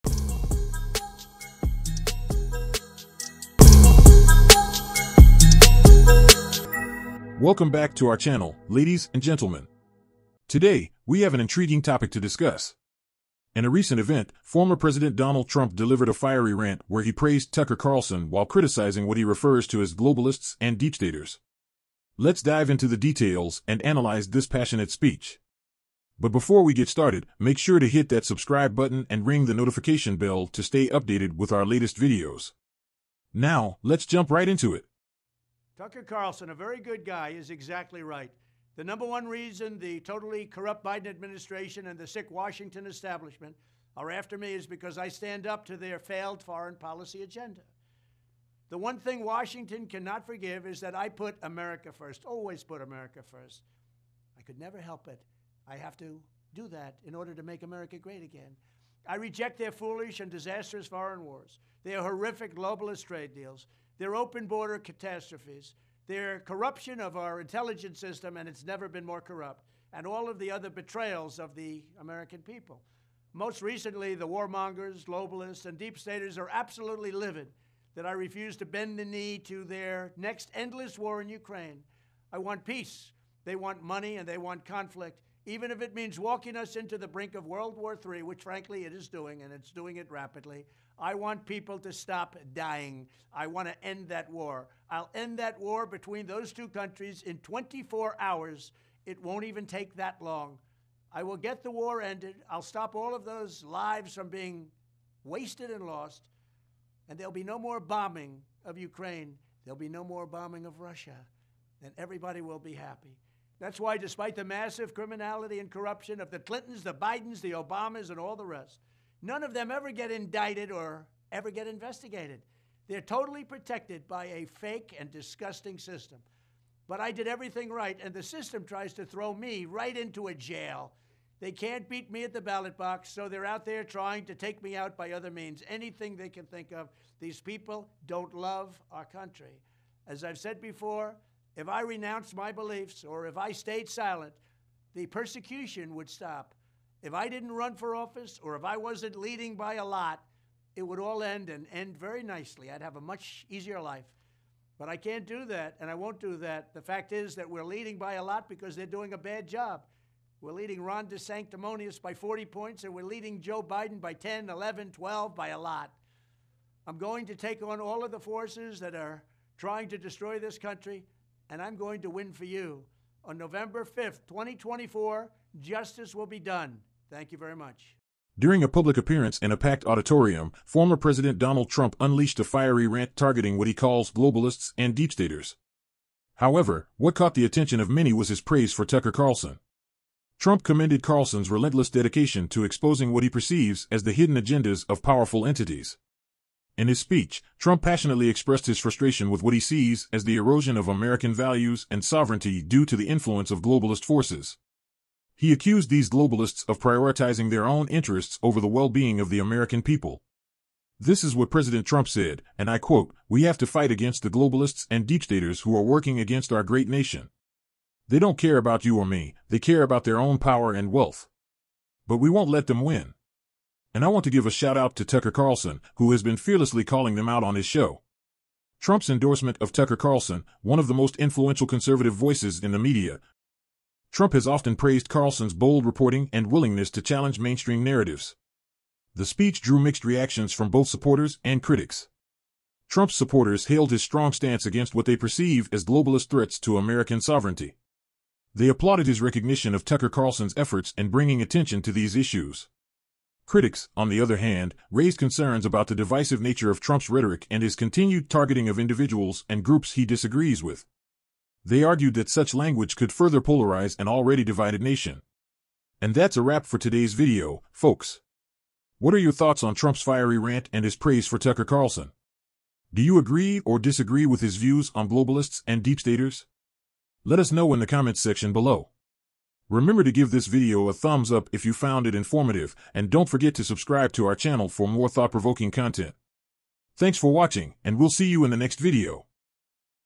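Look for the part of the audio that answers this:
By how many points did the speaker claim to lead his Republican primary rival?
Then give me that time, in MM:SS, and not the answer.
02:42.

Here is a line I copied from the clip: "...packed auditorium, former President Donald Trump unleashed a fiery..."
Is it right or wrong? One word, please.
right.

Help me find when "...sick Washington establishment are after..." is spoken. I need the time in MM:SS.
00:42.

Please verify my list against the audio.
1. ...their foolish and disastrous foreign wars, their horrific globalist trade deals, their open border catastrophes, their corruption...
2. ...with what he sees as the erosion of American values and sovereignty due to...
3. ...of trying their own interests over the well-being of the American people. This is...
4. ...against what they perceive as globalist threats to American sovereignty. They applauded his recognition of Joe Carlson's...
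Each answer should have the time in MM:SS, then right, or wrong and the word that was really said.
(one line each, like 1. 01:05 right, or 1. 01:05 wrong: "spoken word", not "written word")
1. 00:59 right
2. 03:19 right
3. 03:26 wrong: "prioritizing", not "trying"
4. 04:04 wrong: "Tucker", not "Joe".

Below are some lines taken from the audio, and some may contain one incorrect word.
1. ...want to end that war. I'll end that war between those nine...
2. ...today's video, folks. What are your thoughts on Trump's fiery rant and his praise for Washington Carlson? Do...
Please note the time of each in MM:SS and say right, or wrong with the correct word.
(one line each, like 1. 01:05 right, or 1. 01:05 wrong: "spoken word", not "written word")
1. 01:33 wrong: "two", not "nine"
2. 04:26 wrong: "Tucker", not "Washington".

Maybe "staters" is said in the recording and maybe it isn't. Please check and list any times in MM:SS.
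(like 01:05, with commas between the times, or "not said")
00:20, 01:15, 03:05, 03:35, 04:35.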